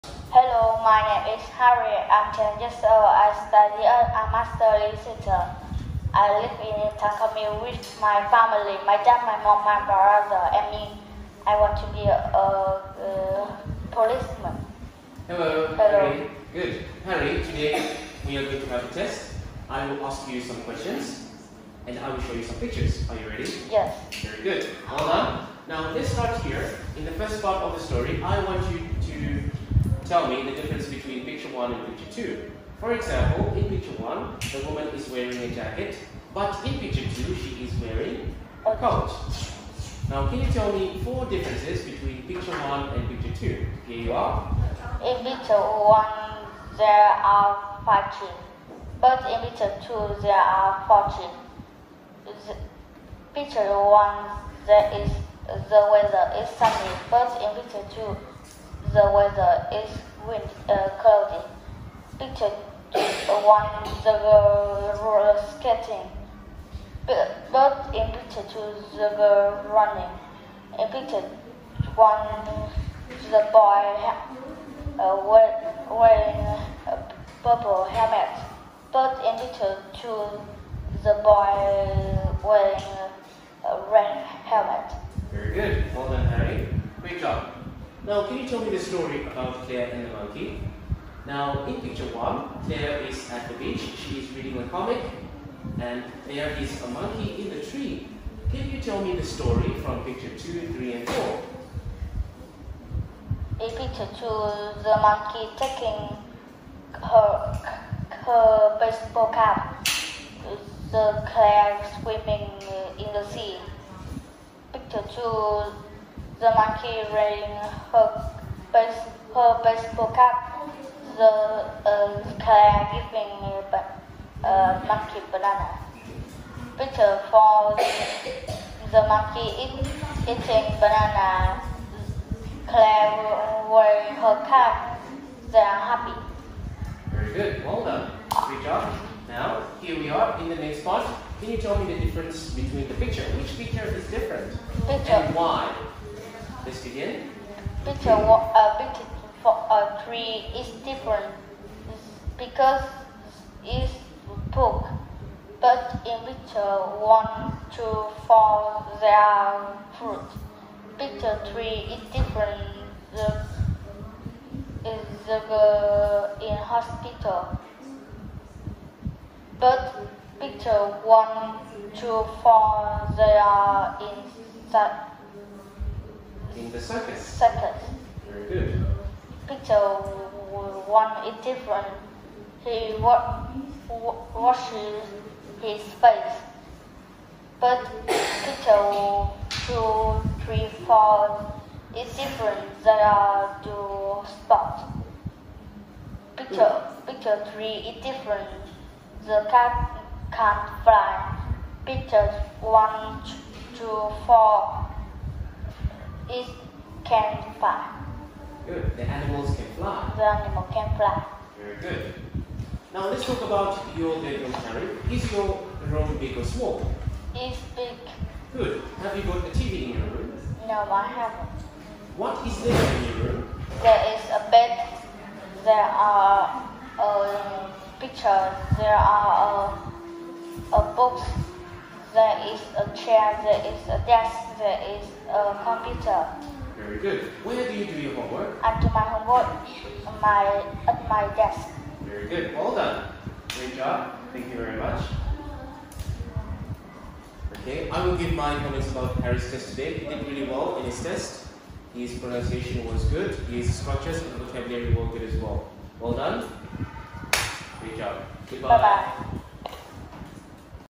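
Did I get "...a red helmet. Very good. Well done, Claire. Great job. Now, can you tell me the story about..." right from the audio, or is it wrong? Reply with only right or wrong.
wrong.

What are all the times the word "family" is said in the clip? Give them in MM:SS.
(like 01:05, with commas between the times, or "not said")
00:08.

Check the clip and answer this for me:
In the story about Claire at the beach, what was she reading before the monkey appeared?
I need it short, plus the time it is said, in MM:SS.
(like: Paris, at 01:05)
a comic, at 01:34.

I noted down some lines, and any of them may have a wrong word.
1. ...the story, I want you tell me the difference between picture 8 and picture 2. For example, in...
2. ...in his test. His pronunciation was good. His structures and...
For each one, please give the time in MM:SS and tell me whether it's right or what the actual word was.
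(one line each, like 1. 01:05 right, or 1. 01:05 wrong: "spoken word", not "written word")
1. 00:27 wrong: "1", not "8"
2. 04:10 right.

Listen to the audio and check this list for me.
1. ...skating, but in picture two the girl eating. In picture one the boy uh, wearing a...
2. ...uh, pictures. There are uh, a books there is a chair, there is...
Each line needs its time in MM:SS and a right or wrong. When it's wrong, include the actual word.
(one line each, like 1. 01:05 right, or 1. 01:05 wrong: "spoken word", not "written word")
1. 01:05 wrong: "running", not "eating"
2. 03:46 right.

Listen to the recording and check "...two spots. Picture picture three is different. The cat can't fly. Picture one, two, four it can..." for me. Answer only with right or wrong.
right.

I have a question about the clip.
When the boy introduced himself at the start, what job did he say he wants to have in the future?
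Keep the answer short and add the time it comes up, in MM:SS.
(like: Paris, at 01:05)
policeman, at 00:13.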